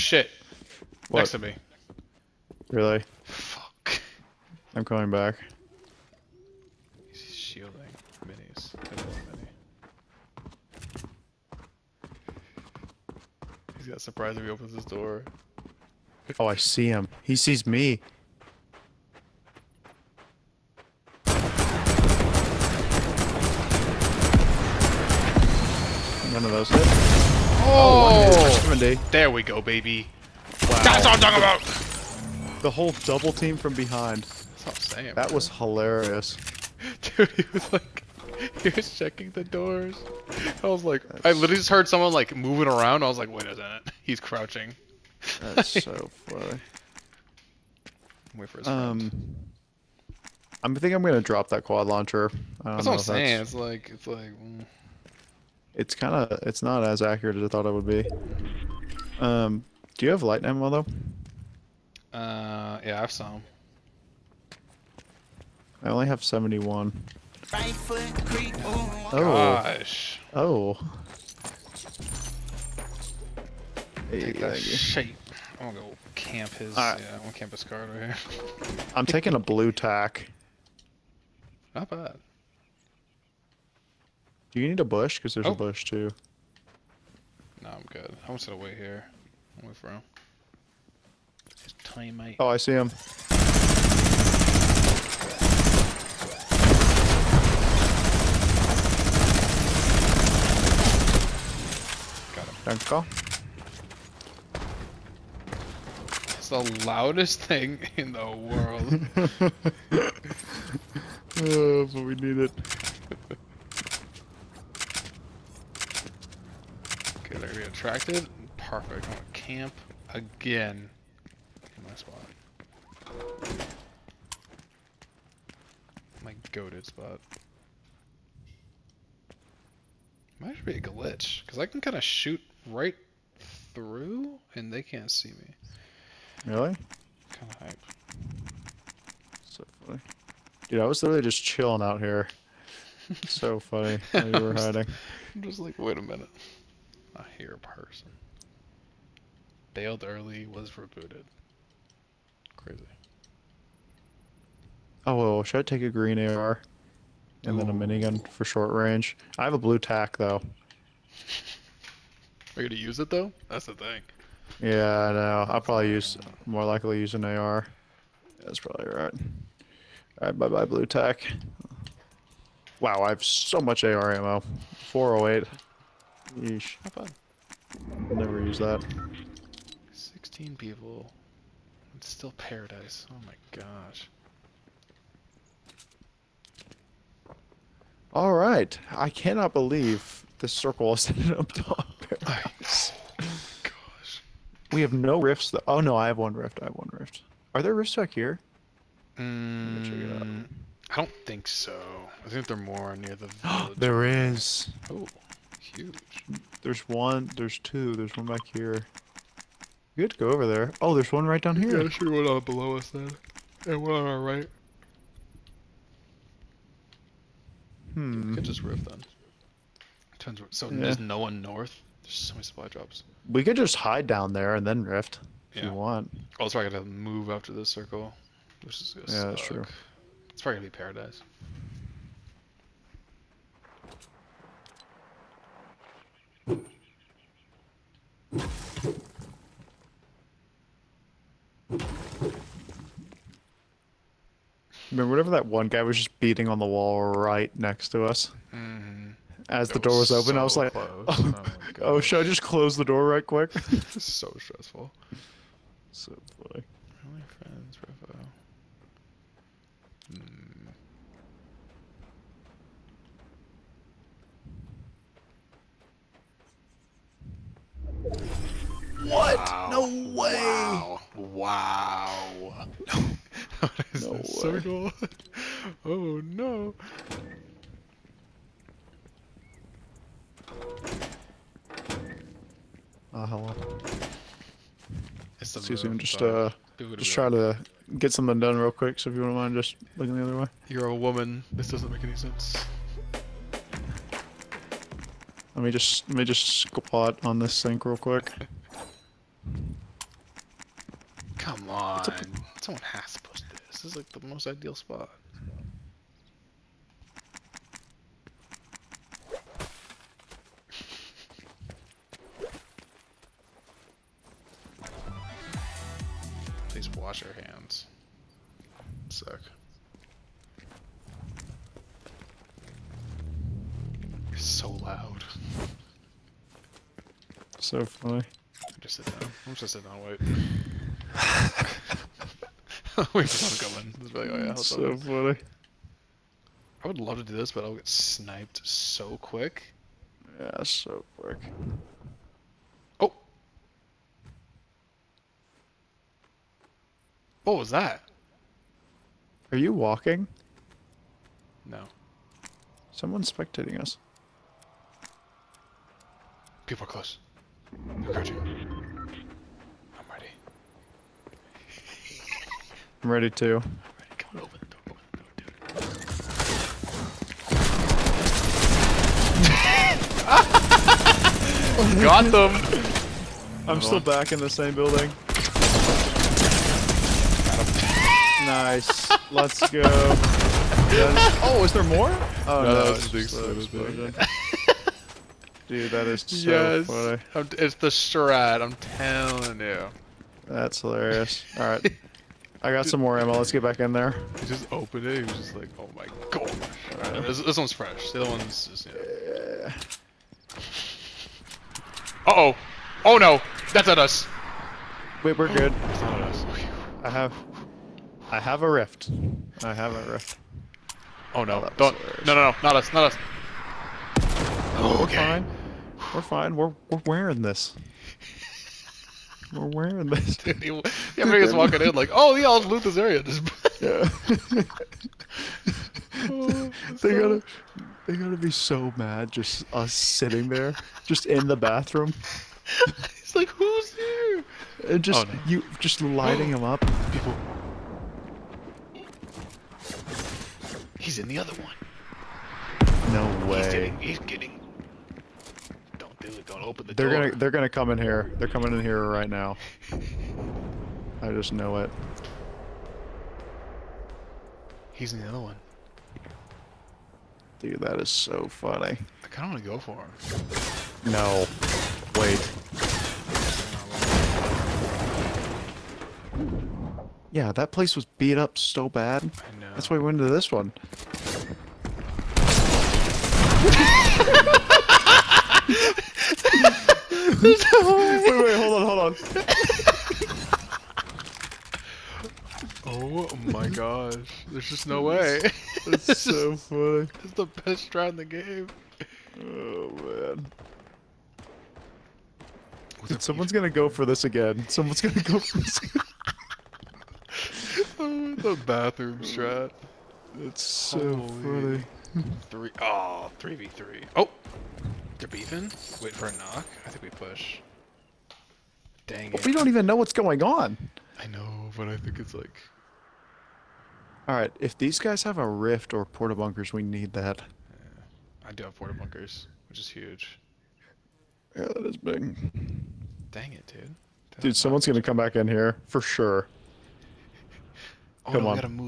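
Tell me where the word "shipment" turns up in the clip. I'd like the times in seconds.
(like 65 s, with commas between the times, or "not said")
not said.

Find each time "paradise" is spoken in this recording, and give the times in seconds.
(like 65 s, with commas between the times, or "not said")
182 s, 192 s, 230 s.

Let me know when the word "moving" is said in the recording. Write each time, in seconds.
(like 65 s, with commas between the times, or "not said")
42 s.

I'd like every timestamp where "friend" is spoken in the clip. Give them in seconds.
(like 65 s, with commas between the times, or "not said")
49 s, 257 s.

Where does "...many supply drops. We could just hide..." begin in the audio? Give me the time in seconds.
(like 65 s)
222 s.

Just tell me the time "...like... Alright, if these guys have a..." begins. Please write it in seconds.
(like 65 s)
512 s.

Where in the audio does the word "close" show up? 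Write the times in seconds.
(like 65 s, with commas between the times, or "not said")
252 s, 356 s.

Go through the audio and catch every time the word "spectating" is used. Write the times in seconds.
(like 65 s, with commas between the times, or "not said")
353 s.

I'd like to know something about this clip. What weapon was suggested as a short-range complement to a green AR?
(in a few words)
minigun.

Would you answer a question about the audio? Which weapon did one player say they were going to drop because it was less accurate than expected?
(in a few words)
quad launcher.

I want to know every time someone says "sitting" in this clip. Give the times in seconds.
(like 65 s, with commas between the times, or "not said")
329 s, 429 s.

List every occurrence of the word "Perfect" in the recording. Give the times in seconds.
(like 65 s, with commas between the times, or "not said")
118 s.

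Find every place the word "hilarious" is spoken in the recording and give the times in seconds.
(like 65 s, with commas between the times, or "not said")
35 s, 390 s.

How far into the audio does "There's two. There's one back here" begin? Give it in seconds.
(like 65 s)
207 s.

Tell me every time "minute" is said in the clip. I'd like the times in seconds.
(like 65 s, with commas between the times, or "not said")
43 s, 146 s.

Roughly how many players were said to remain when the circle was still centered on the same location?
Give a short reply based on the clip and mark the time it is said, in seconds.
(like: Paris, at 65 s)
16, at 179 s.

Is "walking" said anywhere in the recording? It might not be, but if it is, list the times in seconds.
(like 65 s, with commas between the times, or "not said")
349 s, 421 s.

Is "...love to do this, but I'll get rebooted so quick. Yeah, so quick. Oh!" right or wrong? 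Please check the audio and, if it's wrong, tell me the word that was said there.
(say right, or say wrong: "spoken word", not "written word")
wrong: "sniped", not "rebooted".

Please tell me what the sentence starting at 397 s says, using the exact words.
this, this, one's fresh, the other one's just, yeah.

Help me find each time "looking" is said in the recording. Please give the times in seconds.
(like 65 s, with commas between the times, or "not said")
289 s.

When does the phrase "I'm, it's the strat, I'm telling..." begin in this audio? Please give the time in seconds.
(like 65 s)
387 s.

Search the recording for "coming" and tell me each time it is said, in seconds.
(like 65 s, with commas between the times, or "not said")
4 s, 448 s.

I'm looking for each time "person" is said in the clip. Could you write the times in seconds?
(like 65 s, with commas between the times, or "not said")
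147 s.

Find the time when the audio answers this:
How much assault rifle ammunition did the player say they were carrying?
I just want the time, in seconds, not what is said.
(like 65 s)
174 s.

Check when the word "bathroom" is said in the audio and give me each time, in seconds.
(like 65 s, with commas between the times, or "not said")
431 s, 498 s.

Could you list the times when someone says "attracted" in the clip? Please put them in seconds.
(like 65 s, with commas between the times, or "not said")
117 s.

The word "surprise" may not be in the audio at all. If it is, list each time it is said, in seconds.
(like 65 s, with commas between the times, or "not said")
14 s.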